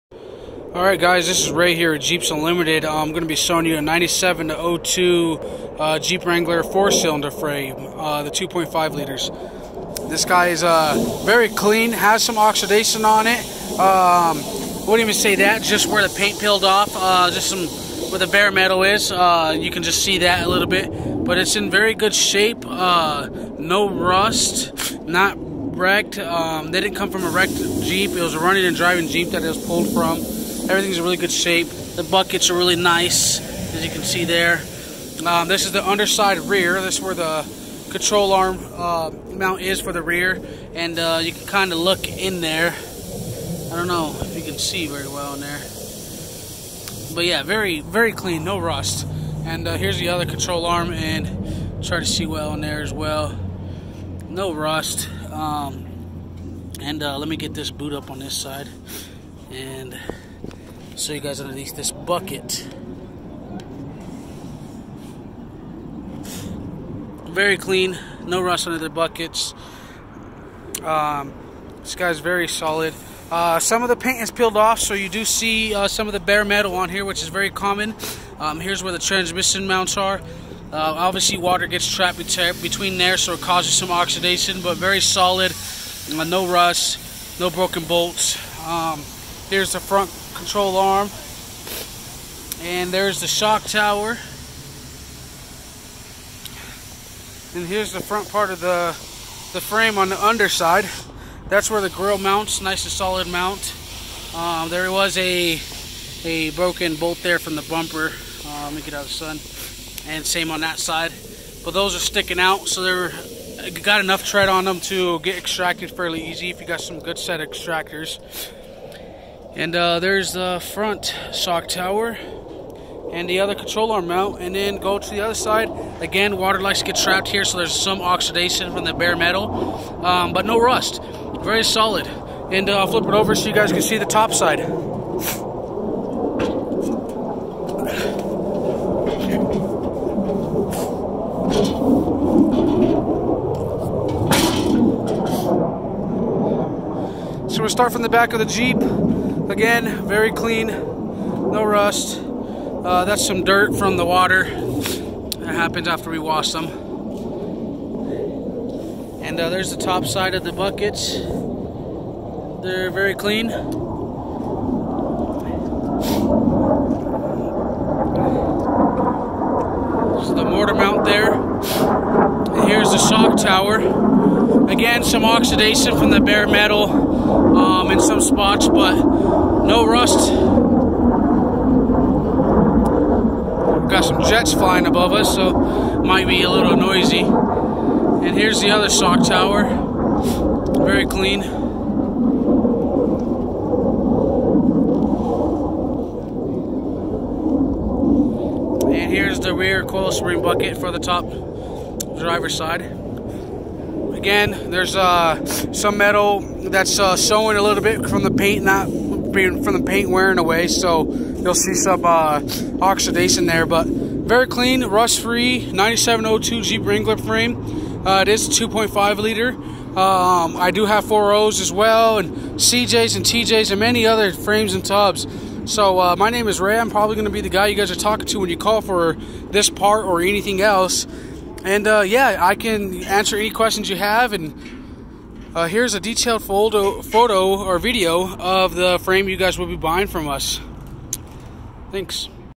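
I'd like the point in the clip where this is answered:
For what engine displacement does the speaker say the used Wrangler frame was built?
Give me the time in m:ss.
0:08.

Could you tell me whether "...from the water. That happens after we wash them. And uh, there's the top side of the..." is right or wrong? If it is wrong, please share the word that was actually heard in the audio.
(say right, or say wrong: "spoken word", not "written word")
right.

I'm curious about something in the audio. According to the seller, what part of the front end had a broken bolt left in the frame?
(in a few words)
The bumper.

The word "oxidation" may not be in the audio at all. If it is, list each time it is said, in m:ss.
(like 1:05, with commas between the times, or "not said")
0:12, 1:23, 2:55, 3:32.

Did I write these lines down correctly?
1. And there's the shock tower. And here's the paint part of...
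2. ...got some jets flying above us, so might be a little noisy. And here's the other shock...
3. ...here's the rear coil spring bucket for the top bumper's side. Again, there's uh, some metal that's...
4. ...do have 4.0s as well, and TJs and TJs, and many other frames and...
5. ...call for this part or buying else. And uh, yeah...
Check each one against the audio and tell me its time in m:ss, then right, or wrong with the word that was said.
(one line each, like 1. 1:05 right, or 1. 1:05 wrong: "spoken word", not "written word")
1. 1:32 wrong: "front", not "paint"
2. 3:03 right
3. 3:19 wrong: "driver", not "bumper"
4. 3:40 wrong: "CJs", not "TJs"
5. 3:48 wrong: "anything", not "buying".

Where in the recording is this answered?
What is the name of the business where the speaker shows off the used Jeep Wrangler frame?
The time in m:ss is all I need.
0:01.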